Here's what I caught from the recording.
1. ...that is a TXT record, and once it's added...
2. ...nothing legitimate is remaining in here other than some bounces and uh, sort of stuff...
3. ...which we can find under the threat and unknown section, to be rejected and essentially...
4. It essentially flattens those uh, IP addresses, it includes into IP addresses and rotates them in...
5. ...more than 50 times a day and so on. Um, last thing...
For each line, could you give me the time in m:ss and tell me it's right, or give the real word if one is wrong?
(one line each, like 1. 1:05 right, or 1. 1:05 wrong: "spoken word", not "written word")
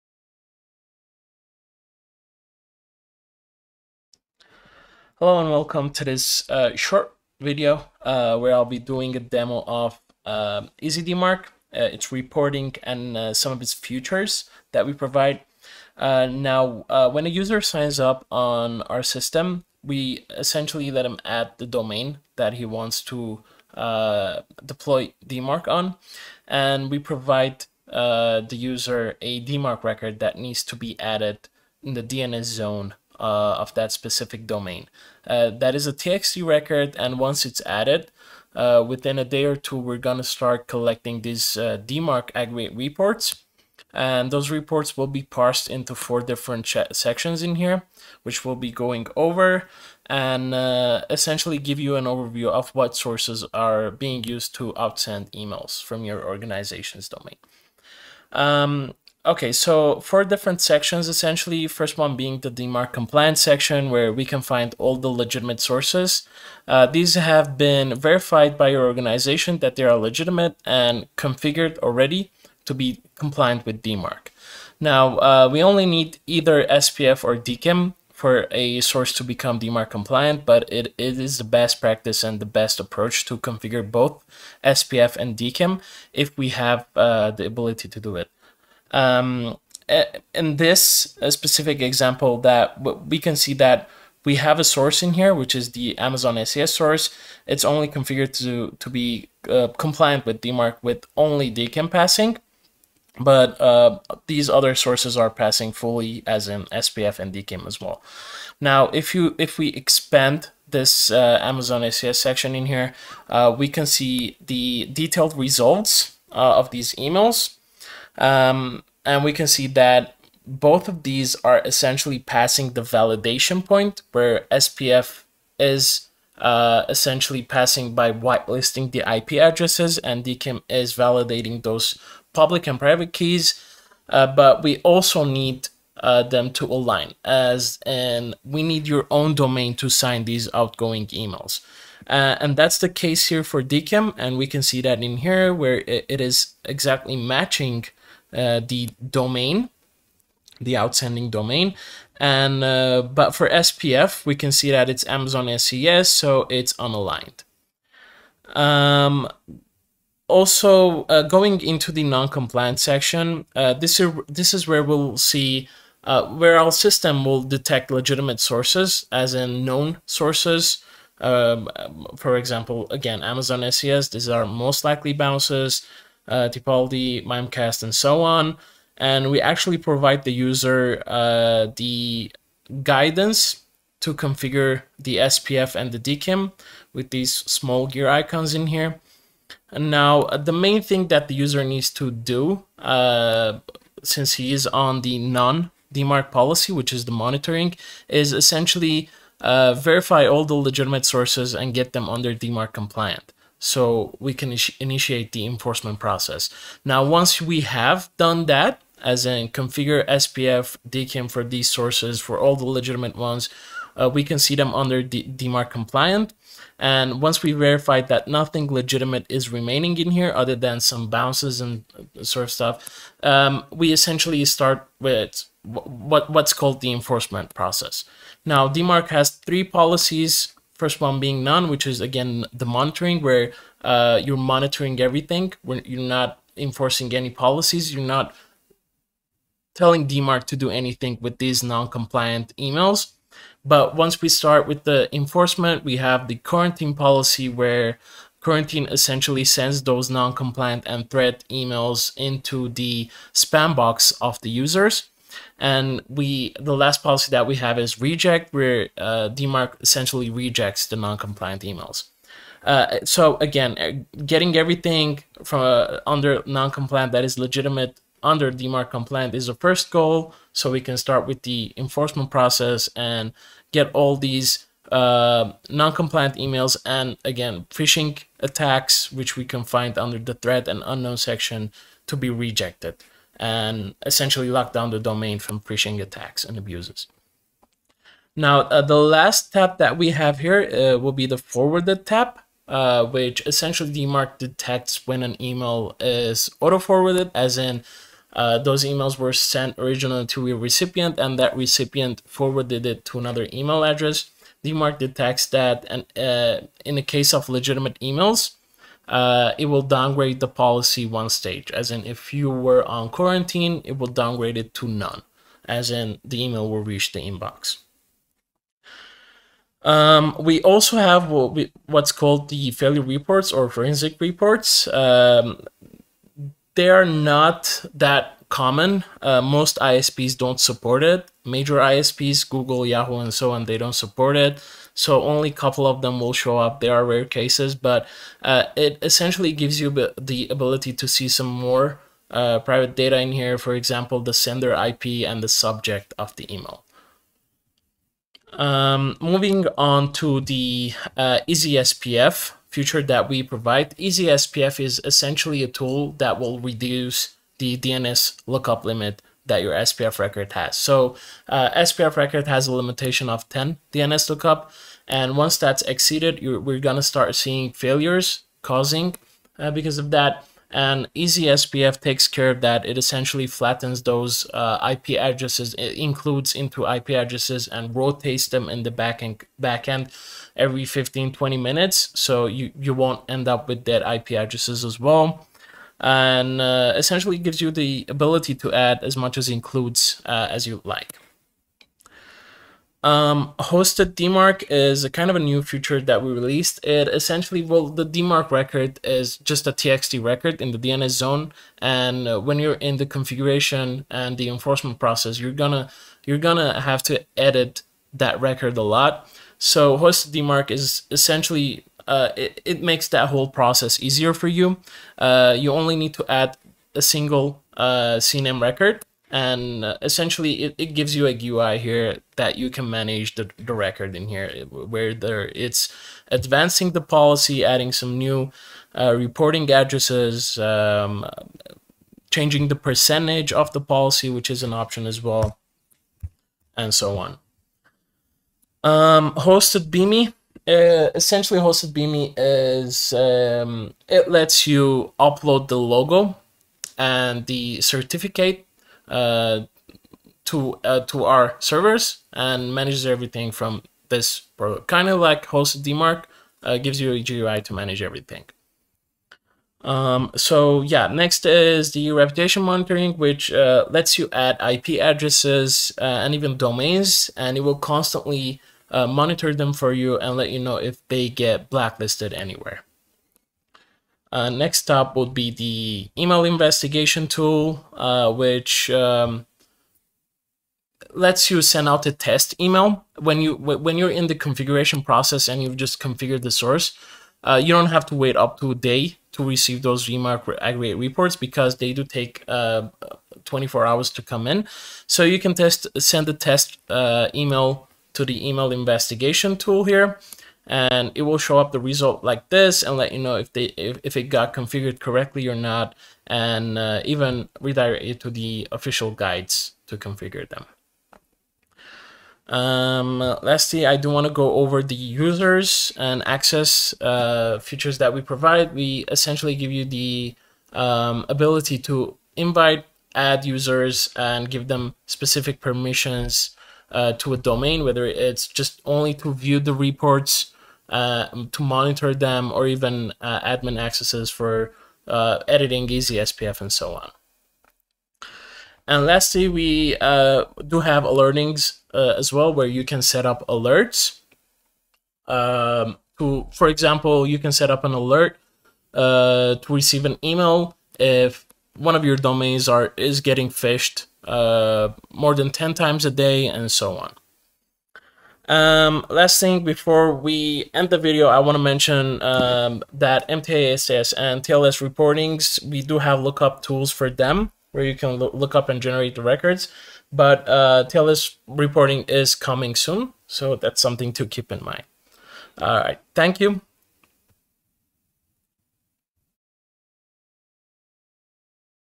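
1. 0:35 right
2. 3:38 right
3. 4:39 right
4. 6:12 right
5. 9:15 wrong: "10", not "50".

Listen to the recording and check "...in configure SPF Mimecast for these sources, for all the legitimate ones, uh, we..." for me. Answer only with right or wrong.
wrong.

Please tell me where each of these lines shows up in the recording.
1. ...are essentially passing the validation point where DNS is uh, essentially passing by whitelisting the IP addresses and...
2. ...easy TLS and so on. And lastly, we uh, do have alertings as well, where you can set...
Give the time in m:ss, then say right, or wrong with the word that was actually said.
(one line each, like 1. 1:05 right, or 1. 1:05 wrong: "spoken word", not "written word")
1. 2:01 wrong: "SPF", not "DNS"
2. 8:55 wrong: "SPF", not "TLS".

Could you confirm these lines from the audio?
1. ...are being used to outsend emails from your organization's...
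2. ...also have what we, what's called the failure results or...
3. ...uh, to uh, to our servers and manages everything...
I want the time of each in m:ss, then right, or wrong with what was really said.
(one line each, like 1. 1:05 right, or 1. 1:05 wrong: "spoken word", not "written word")
1. 0:53 right
2. 5:20 wrong: "reports", not "results"
3. 7:29 right.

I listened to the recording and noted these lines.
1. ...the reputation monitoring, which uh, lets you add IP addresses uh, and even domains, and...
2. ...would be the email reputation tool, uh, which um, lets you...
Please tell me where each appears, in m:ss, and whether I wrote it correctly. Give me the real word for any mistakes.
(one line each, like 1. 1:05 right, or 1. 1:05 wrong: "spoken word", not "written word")
1. 7:41 right
2. 7:55 wrong: "investigation", not "reputation".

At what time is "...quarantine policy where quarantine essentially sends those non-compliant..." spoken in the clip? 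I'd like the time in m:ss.
4:06.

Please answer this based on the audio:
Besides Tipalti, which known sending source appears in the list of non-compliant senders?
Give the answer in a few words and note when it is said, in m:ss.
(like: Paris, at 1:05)
Mimecast, at 2:57.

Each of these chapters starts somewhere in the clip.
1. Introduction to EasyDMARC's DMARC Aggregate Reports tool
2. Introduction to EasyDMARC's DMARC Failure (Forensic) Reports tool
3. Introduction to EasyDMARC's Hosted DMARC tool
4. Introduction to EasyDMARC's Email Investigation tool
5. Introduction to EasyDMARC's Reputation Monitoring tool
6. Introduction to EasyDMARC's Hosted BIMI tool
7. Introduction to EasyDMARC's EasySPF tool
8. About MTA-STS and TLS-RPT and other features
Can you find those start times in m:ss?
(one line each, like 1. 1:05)
1. 0:35
2. 5:20
3. 6:31
4. 7:53
5. 7:39
6. 7:18
7. 5:47
8. 8:58.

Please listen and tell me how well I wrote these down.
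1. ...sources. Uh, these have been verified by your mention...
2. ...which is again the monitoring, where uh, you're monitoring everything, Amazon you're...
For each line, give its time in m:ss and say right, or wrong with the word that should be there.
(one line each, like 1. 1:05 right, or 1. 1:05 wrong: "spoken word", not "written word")
1. 1:05 wrong: "organization", not "mention"
2. 3:51 wrong: "When", not "Amazon".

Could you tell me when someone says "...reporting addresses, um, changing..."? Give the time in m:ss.
7:09.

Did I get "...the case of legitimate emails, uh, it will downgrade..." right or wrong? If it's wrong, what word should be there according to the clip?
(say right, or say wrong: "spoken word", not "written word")
right.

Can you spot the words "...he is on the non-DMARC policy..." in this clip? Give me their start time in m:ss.
3:14.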